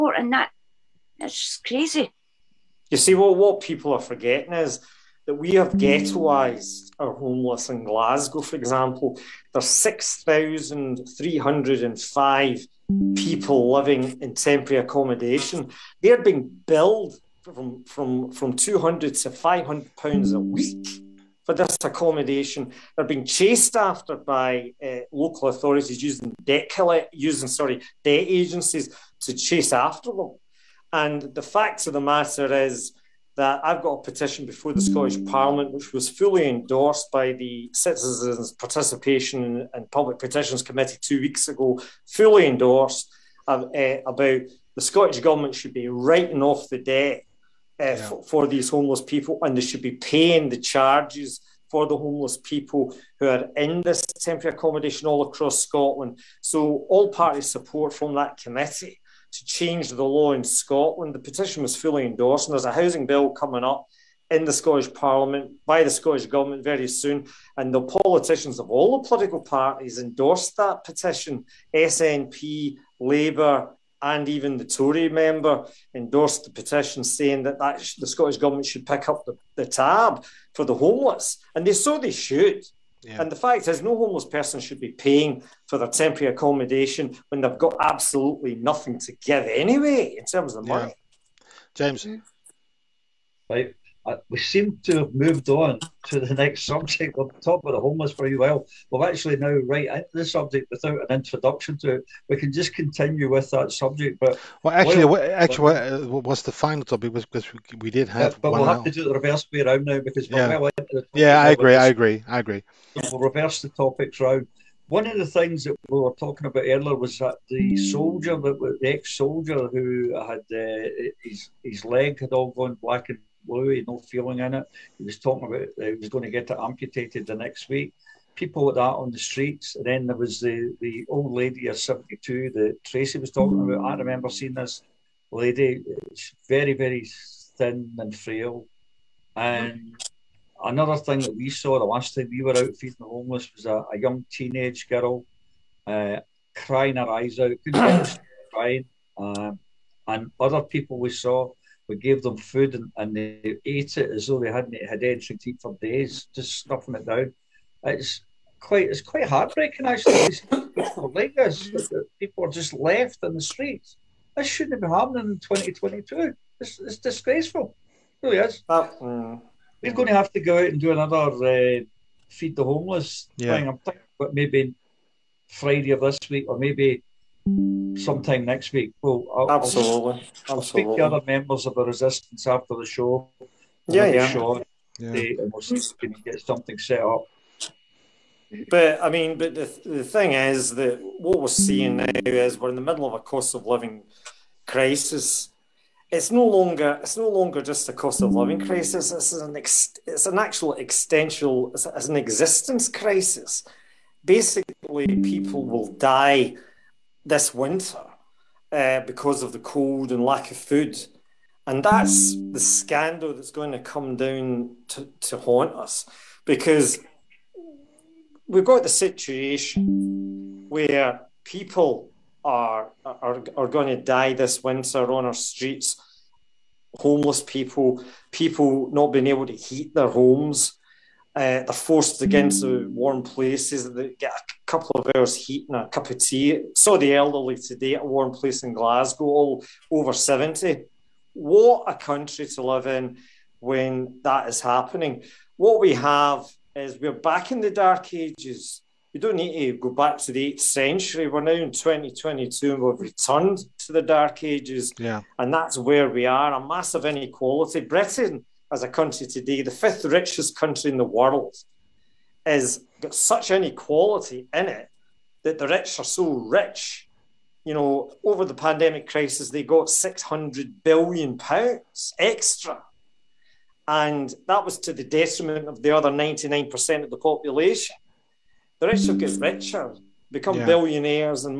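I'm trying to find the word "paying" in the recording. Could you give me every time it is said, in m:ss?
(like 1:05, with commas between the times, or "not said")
0:49, 1:24.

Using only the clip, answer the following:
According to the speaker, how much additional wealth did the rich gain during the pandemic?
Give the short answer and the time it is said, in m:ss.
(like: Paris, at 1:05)
600 billion pounds, at 4:29.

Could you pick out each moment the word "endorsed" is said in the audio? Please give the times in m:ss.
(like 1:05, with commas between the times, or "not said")
0:36, 0:42, 1:02, 1:09, 1:15.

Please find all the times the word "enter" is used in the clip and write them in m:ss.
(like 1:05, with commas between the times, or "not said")
not said.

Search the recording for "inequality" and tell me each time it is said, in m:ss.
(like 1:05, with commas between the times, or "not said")
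4:17, 4:23.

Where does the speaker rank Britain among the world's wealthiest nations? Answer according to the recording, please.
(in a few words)
fifth.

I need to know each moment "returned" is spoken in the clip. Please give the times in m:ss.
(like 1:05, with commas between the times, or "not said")
4:12.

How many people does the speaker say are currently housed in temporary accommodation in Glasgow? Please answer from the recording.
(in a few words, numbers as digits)
6,305.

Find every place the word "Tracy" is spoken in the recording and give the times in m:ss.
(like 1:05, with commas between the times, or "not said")
2:12.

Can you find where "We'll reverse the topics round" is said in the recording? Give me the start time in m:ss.
1:53.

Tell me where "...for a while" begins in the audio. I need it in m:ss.
1:38.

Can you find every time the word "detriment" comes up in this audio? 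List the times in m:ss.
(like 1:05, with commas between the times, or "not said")
4:35.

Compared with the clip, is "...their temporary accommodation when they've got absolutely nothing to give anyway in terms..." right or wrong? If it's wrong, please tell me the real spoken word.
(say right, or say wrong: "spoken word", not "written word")
right.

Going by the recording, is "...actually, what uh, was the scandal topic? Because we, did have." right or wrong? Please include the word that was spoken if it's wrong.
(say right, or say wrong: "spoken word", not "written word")
wrong: "final", not "scandal".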